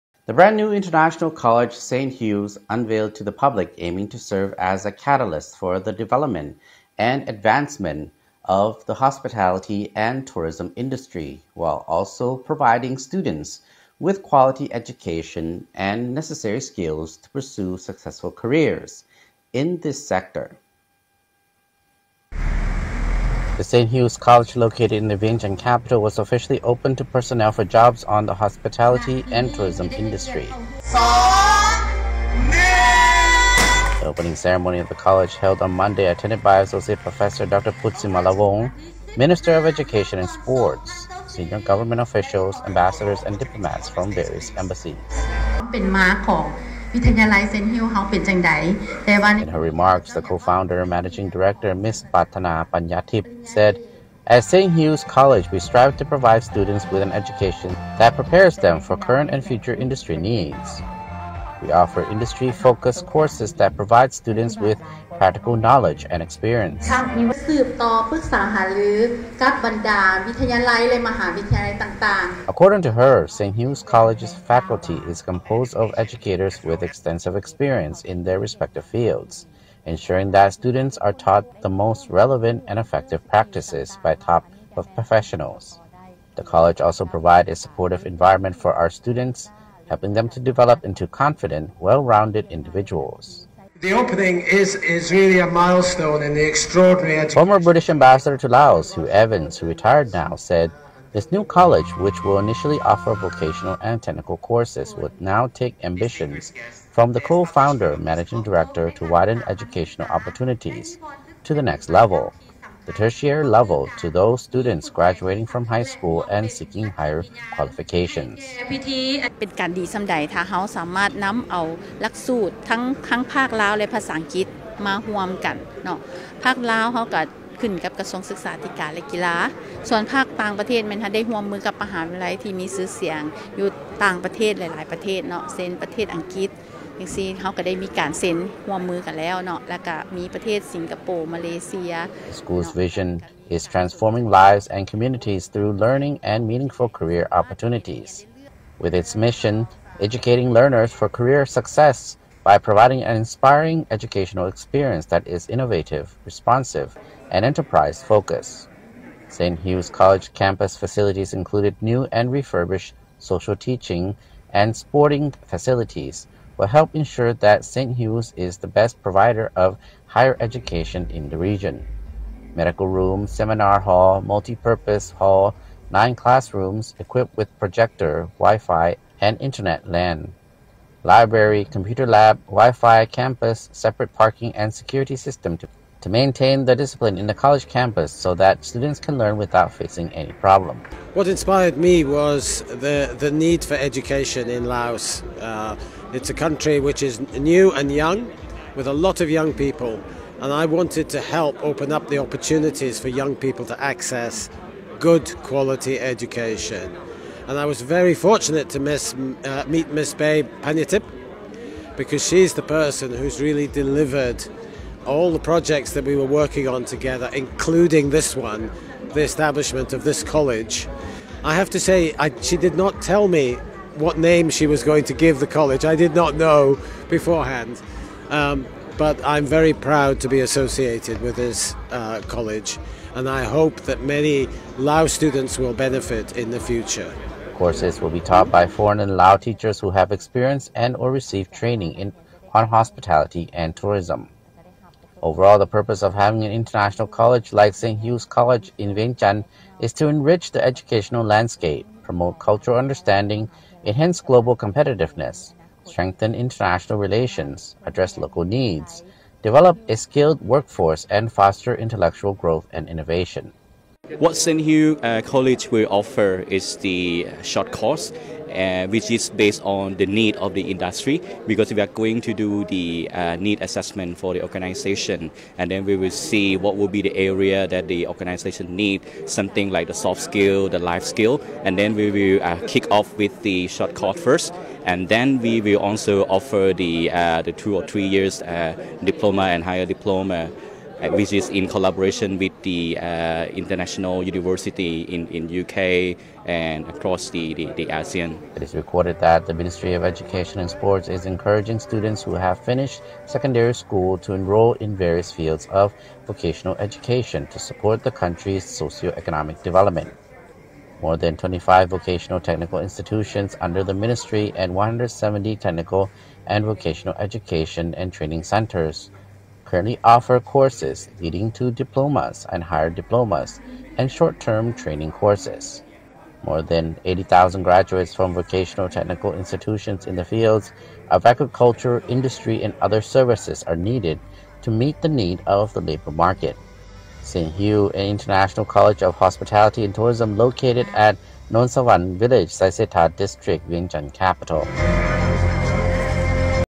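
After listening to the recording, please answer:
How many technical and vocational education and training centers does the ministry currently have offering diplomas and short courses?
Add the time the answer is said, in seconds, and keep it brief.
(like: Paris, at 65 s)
170, at 314 s.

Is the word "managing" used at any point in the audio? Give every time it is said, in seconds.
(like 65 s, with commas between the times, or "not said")
50 s, 107 s.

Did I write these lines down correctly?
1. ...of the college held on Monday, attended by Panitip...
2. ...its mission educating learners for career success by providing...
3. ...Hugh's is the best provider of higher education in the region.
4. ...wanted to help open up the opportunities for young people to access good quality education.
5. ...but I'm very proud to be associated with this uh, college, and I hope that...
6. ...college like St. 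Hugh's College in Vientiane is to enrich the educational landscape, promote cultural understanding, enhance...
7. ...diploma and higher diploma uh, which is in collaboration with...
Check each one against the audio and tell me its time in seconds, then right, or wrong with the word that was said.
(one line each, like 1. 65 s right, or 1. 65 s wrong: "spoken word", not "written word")
1. 34 s wrong: "Associate", not "Panitip"
2. 148 s right
3. 167 s right
4. 200 s right
5. 228 s right
6. 247 s right
7. 289 s right.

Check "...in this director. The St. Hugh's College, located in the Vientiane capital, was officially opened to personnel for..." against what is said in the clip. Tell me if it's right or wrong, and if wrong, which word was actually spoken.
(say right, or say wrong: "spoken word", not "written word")
wrong: "sector", not "director".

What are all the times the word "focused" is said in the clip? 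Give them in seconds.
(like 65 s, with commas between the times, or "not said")
62 s, 158 s.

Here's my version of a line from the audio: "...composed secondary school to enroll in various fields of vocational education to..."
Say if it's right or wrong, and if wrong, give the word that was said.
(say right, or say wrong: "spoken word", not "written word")
wrong: "finished", not "composed".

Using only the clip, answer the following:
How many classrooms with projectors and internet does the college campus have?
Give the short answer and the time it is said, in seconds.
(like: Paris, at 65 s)
9, at 175 s.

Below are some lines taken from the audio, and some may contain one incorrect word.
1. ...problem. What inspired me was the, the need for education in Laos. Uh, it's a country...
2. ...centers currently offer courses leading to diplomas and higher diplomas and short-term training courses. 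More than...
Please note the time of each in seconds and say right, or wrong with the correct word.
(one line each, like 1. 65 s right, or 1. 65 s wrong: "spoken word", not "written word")
1. 190 s right
2. 318 s right.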